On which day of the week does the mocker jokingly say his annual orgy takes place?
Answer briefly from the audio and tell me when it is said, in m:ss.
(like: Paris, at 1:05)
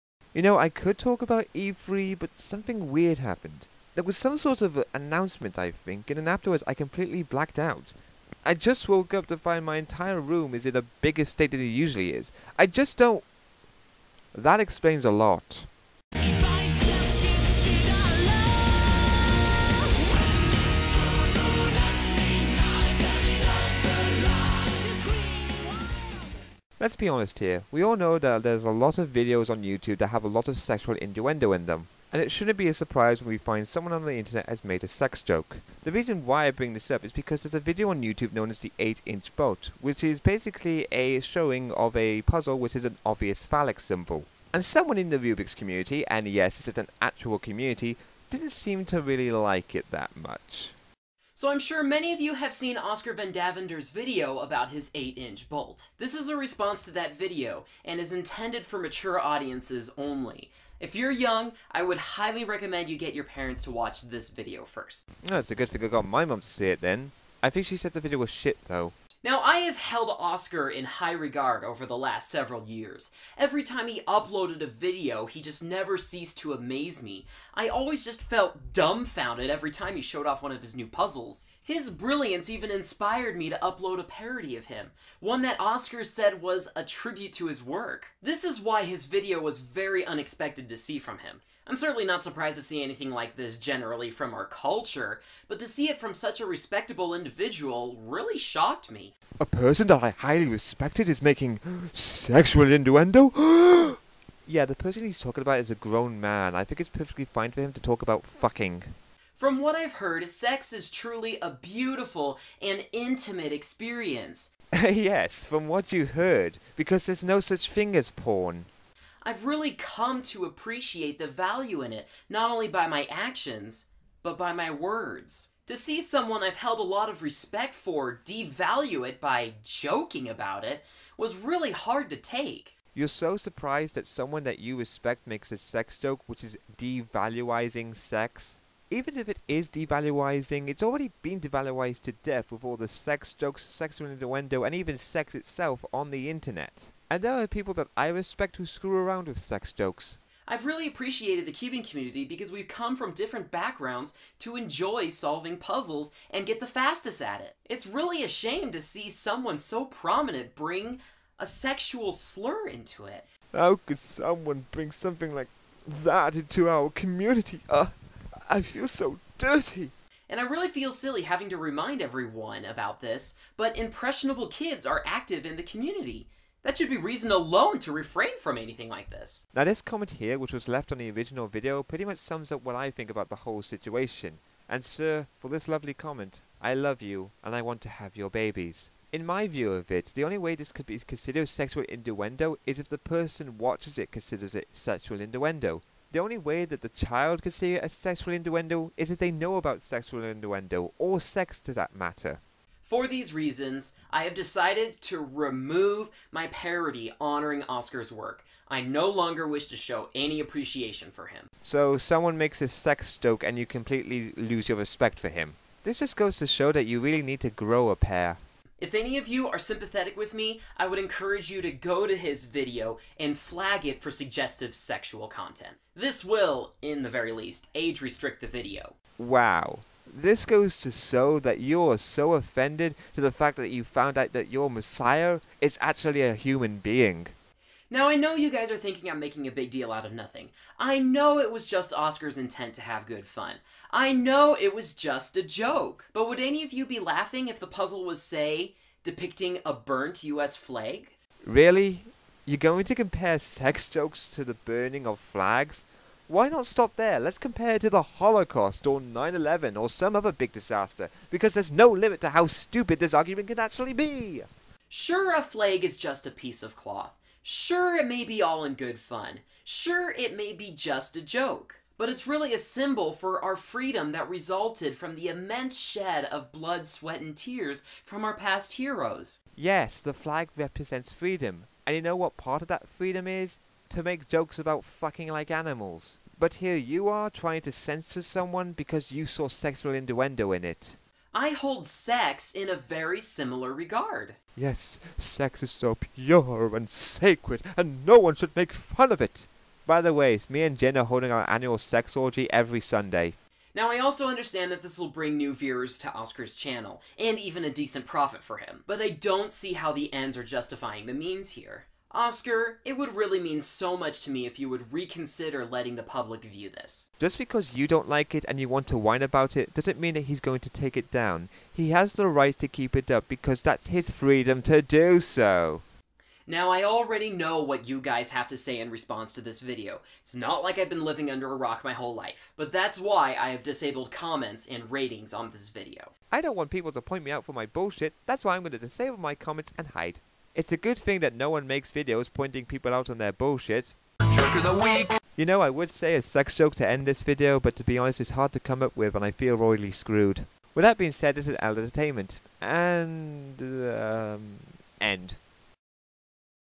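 Sunday, at 5:02.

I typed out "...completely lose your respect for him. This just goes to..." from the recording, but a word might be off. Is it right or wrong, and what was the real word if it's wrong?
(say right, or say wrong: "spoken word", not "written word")
right.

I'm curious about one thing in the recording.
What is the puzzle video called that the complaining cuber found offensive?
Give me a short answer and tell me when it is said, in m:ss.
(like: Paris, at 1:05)
8 inch bolt, at 0:38.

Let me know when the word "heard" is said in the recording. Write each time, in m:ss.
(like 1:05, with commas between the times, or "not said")
1:49, 1:56.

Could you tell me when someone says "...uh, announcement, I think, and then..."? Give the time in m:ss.
0:04.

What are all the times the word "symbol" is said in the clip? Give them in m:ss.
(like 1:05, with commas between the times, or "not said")
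0:43, 4:32.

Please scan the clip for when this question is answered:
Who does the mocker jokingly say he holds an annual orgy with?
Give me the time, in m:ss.
5:00.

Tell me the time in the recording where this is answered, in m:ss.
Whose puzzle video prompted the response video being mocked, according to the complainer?
0:52.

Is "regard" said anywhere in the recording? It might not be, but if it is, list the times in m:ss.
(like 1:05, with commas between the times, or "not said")
1:11, 4:53.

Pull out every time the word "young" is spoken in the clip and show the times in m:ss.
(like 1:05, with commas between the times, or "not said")
1:01.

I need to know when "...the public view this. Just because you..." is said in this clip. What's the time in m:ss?
5:15.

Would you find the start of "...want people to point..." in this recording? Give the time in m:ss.
5:36.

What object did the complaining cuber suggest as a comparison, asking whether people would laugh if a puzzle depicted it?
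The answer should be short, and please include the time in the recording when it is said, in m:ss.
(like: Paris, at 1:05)
burnt US flag, at 4:09.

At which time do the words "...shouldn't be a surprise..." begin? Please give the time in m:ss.
0:32.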